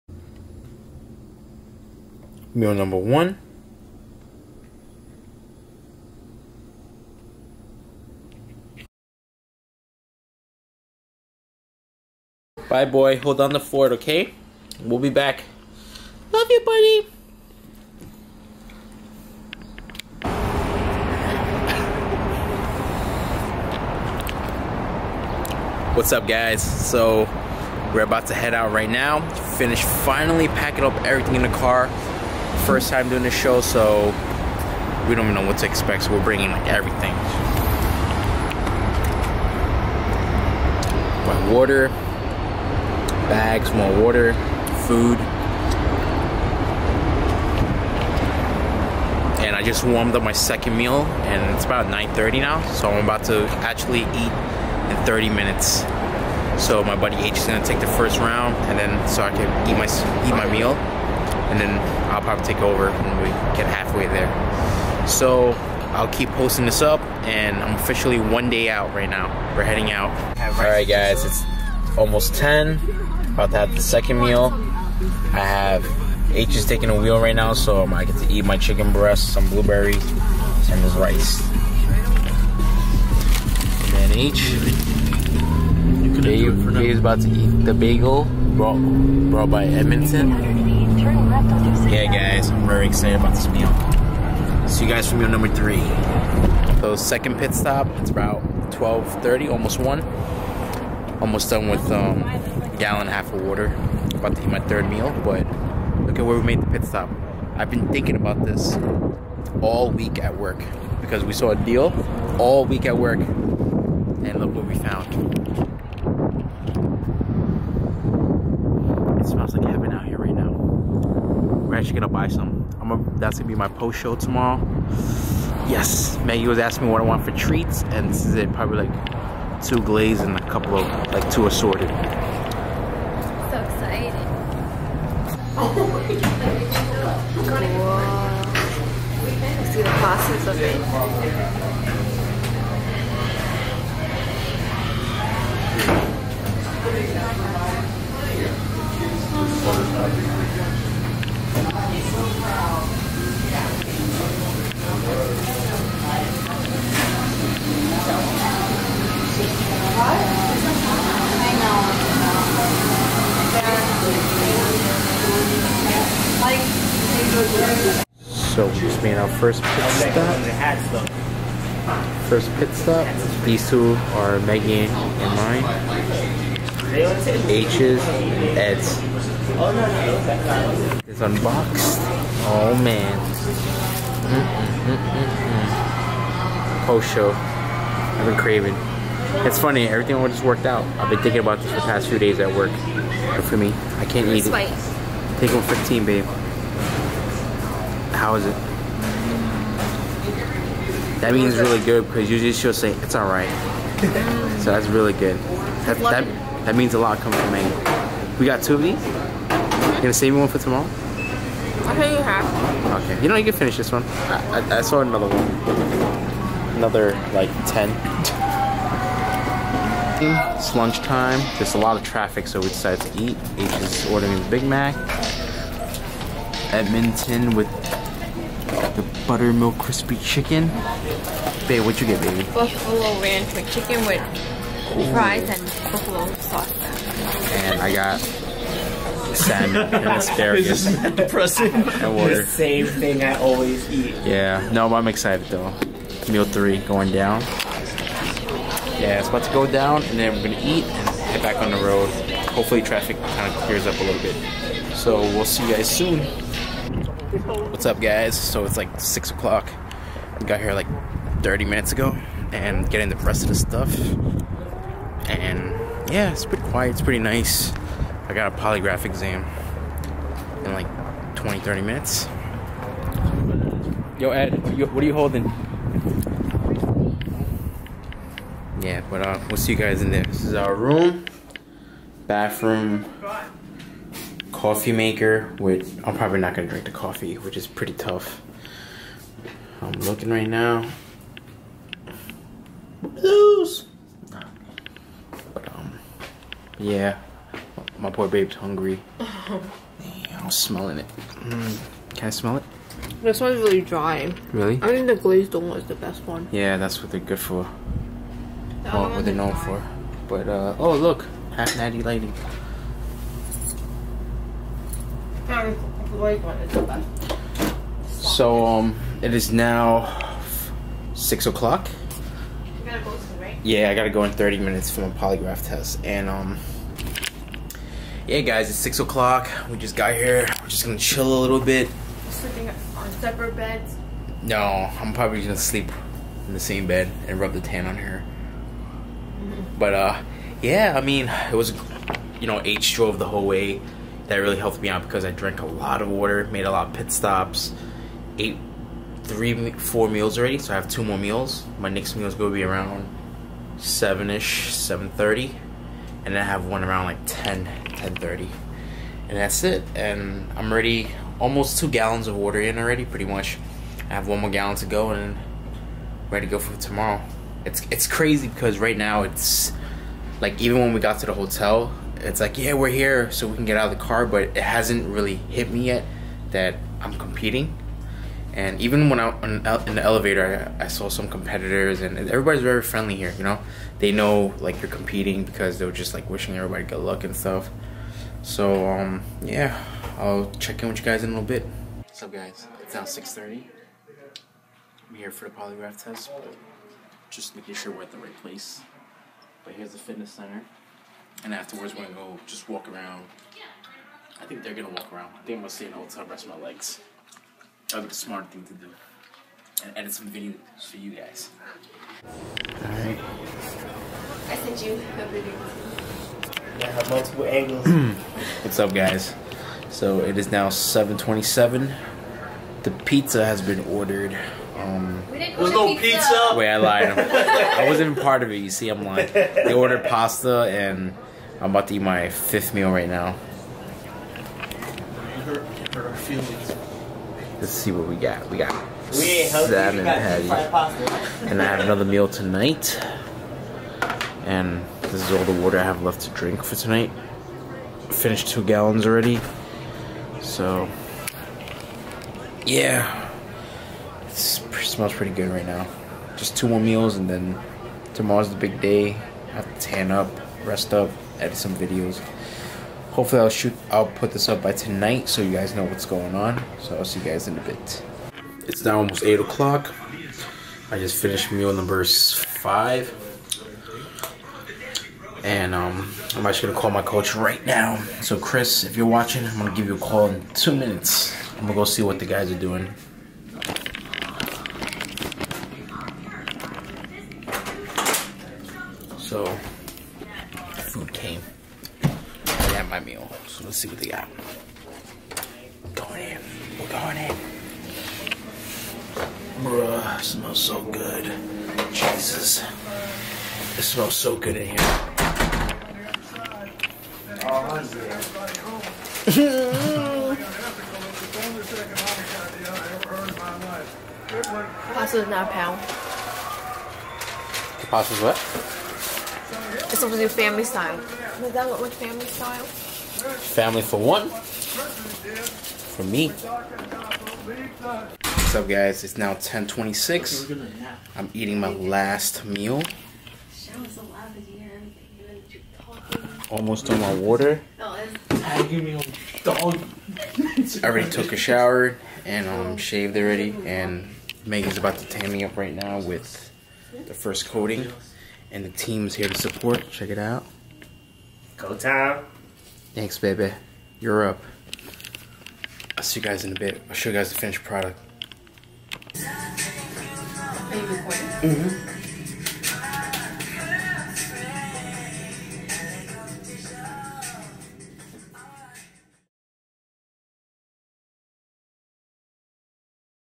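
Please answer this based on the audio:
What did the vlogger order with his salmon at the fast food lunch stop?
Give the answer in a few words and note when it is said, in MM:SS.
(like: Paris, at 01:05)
asparagus, at 04:00.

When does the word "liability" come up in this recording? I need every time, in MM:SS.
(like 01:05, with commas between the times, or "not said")
not said.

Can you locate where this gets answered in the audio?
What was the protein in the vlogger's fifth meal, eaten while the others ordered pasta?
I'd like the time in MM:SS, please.
07:19.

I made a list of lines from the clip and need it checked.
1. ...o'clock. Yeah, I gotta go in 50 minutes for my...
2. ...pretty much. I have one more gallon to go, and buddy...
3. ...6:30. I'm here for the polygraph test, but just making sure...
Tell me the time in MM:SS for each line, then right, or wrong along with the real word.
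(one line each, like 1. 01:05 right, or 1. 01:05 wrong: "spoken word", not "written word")
1. 05:21 wrong: "30", not "50"
2. 06:03 wrong: "ready", not "buddy"
3. 06:33 right.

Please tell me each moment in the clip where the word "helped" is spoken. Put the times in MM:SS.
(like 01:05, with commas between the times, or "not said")
05:44.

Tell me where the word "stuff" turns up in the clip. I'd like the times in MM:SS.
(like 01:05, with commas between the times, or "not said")
04:23, 06:27.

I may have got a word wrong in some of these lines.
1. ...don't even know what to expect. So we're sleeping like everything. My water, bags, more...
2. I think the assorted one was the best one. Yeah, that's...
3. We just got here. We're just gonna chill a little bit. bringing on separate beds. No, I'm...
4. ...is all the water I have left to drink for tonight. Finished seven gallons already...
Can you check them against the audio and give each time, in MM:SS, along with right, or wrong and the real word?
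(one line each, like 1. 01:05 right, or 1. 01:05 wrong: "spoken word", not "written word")
1. 00:35 wrong: "bringing", not "sleeping"
2. 05:04 wrong: "glazed", not "assorted"
3. 05:29 wrong: "sleeping", not "bringing"
4. 07:25 wrong: "two", not "seven".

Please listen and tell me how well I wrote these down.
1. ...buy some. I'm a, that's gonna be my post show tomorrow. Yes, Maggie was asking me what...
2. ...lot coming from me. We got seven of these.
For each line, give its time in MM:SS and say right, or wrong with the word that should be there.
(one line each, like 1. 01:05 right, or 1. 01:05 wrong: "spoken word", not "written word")
1. 02:02 right
2. 03:26 wrong: "two", not "seven".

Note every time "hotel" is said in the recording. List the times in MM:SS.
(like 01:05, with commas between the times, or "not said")
06:11, 06:45.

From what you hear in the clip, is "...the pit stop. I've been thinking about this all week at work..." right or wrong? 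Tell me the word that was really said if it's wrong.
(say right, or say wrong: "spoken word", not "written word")
right.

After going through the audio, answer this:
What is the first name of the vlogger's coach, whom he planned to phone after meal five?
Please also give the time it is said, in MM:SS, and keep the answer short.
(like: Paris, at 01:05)
Chris, at 07:58.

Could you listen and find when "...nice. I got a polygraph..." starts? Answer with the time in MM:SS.
04:27.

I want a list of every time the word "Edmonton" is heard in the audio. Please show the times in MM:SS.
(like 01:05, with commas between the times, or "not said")
01:29, 03:46.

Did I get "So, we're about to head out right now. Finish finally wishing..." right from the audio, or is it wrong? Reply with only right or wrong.
wrong.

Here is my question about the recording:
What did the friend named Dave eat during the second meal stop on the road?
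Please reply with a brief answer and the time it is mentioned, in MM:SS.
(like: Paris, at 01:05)
bagel, at 01:27.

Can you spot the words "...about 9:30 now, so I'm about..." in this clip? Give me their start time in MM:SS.
00:51.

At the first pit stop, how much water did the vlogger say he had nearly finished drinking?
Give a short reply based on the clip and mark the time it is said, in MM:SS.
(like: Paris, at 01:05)
a gallon and a half, at 01:42.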